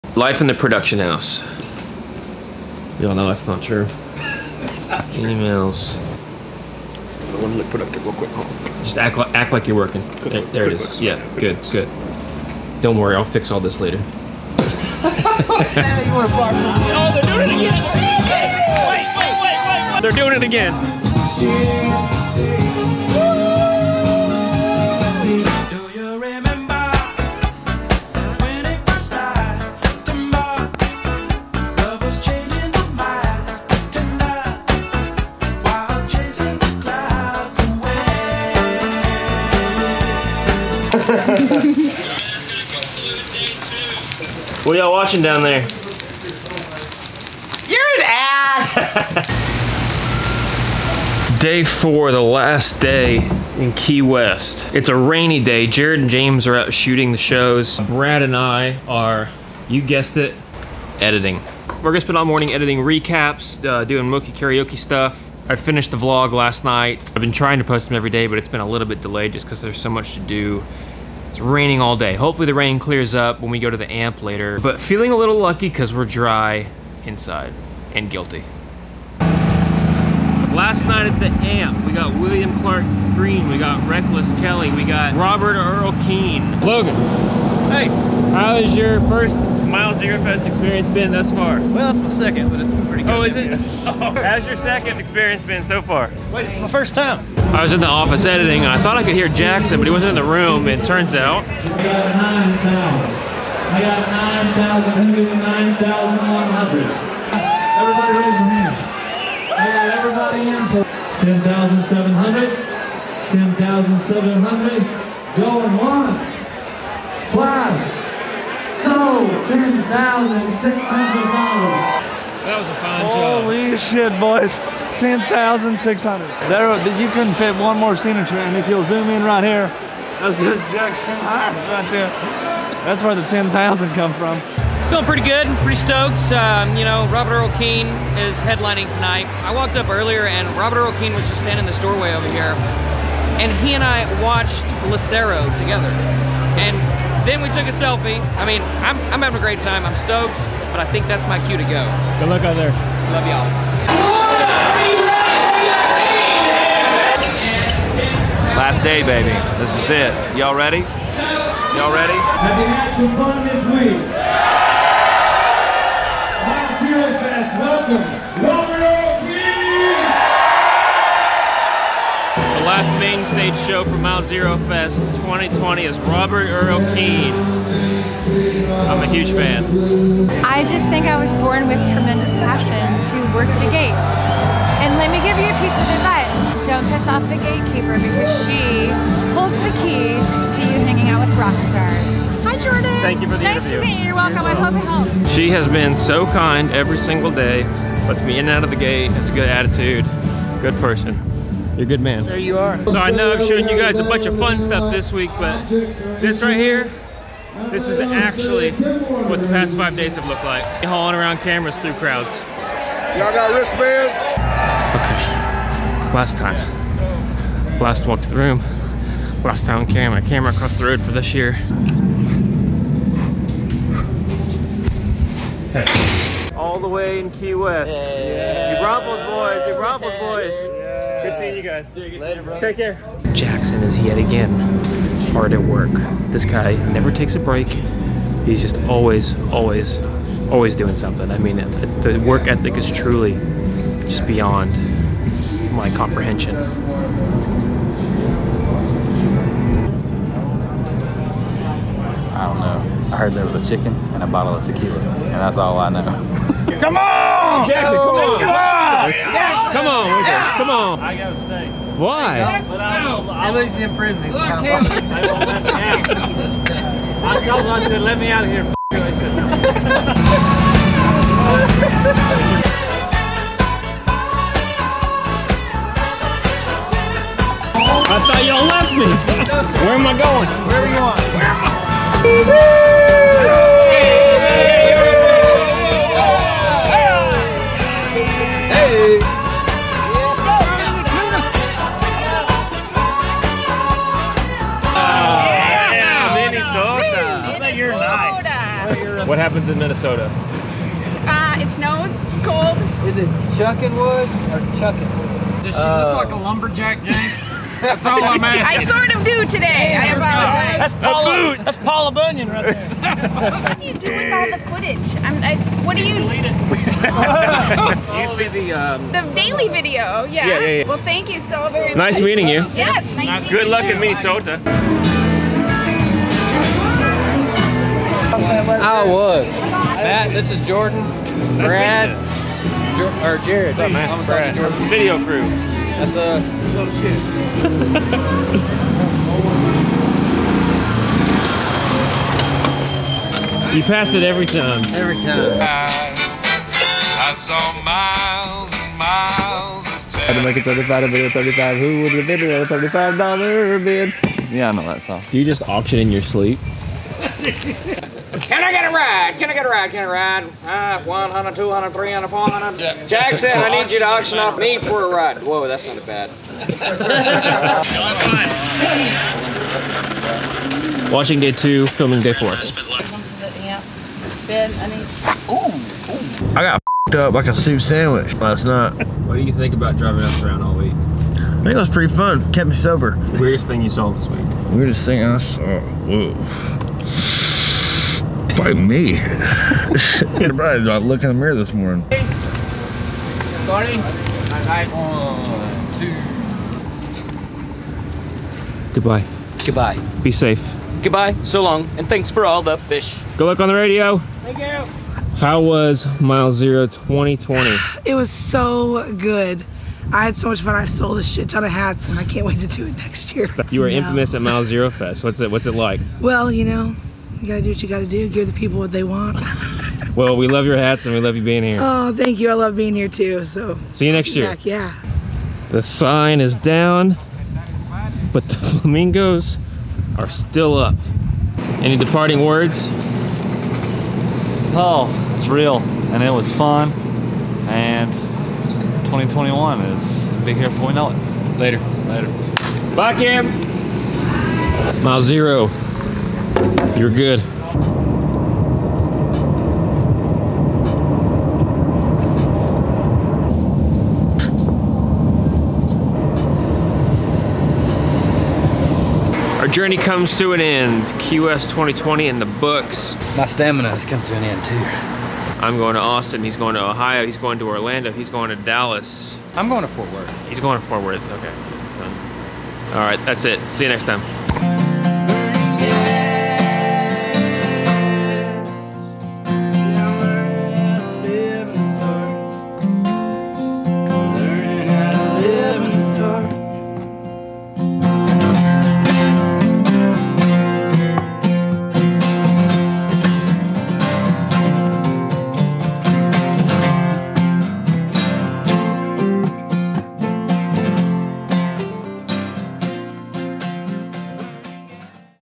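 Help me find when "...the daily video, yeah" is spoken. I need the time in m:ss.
5:19.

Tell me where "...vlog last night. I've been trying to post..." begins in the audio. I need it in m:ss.
1:05.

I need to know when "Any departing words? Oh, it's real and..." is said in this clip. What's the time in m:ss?
7:11.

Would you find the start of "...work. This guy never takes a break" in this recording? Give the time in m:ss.
3:55.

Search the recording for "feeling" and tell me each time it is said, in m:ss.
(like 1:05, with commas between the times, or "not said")
1:14, 2:14.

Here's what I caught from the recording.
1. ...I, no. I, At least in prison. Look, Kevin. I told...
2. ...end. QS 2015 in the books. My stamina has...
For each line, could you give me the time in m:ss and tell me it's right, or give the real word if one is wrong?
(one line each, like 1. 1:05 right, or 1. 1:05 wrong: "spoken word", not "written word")
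1. 4:22 right
2. 7:40 wrong: "2020", not "2015".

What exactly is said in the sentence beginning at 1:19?
Last night at the amp, we got William Clark Green, we got Reckless Kelly, we got Robert Earl Keen.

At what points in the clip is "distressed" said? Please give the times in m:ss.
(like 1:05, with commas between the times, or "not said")
not said.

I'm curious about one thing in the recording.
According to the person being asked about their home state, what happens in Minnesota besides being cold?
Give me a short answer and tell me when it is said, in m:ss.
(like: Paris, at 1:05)
it snows, at 5:01.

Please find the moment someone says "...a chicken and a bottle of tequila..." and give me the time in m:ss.
4:13.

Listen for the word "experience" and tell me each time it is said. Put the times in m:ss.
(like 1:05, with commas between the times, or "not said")
1:30, 1:34.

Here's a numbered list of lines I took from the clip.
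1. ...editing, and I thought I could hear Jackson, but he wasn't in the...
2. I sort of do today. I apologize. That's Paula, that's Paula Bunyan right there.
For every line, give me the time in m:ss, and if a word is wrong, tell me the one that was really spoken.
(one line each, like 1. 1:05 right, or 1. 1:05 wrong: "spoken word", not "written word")
1. 1:38 right
2. 5:08 right.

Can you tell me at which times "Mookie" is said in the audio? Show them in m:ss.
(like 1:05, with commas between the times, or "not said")
1:04.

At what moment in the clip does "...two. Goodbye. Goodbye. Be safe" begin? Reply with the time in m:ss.
6:38.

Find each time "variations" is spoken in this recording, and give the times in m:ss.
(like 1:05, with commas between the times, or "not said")
not said.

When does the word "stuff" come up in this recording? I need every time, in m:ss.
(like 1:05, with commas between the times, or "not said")
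1:04, 3:24.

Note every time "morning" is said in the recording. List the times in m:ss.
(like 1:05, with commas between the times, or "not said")
1:02, 6:31.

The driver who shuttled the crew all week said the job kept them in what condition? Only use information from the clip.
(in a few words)
sober.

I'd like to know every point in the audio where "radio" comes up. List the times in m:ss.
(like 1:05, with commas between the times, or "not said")
6:43.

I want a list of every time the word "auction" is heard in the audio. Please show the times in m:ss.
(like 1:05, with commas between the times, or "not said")
5:55, 6:04.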